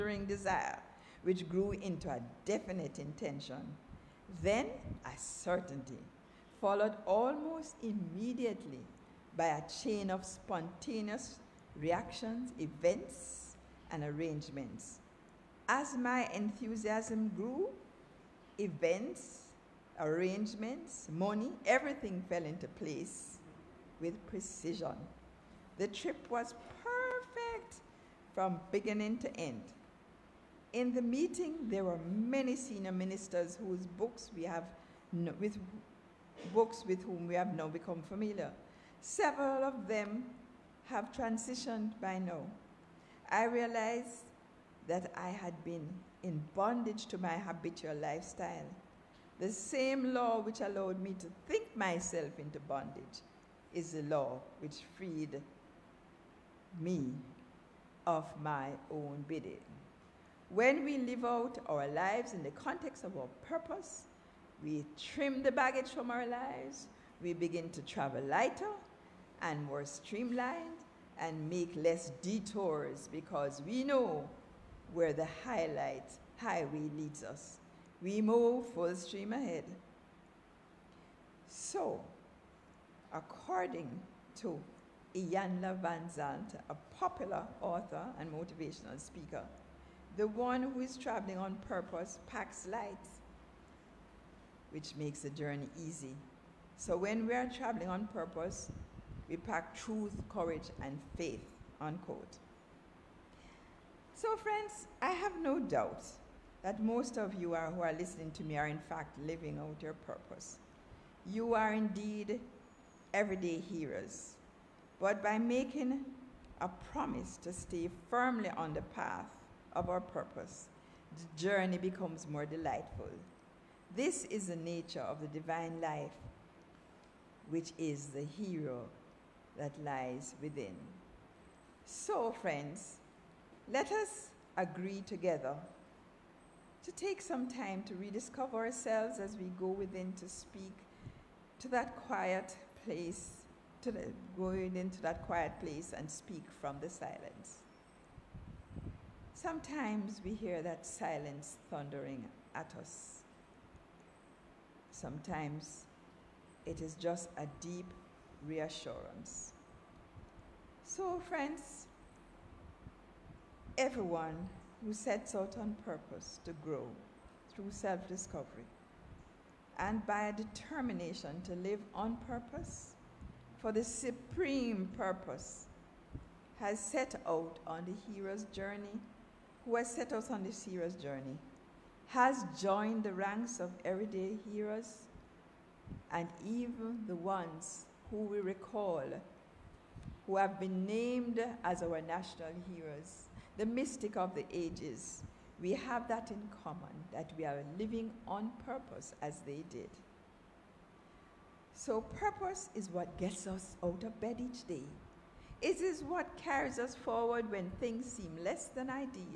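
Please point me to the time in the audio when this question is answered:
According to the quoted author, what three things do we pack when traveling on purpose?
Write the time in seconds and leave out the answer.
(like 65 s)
99 s.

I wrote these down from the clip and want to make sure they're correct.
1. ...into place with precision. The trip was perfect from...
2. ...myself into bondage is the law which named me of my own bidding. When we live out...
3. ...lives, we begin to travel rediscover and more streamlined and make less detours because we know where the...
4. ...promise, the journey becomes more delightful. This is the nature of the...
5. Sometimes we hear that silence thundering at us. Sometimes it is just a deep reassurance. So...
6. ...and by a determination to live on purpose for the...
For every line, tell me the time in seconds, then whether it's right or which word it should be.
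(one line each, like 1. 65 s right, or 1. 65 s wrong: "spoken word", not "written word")
1. 22 s right
2. 51 s wrong: "freed", not "named"
3. 66 s wrong: "lighter", not "rediscover"
4. 120 s wrong: "purpose", not "promise"
5. 149 s right
6. 169 s right.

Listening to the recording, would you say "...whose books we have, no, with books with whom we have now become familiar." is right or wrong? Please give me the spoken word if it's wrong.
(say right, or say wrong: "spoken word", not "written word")
right.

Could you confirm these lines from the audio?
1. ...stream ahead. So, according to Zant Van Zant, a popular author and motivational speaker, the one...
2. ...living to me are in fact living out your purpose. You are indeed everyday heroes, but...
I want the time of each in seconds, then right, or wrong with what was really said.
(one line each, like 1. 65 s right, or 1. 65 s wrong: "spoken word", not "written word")
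1. 78 s wrong: "Iyanla", not "Zant"
2. 107 s wrong: "listening", not "living".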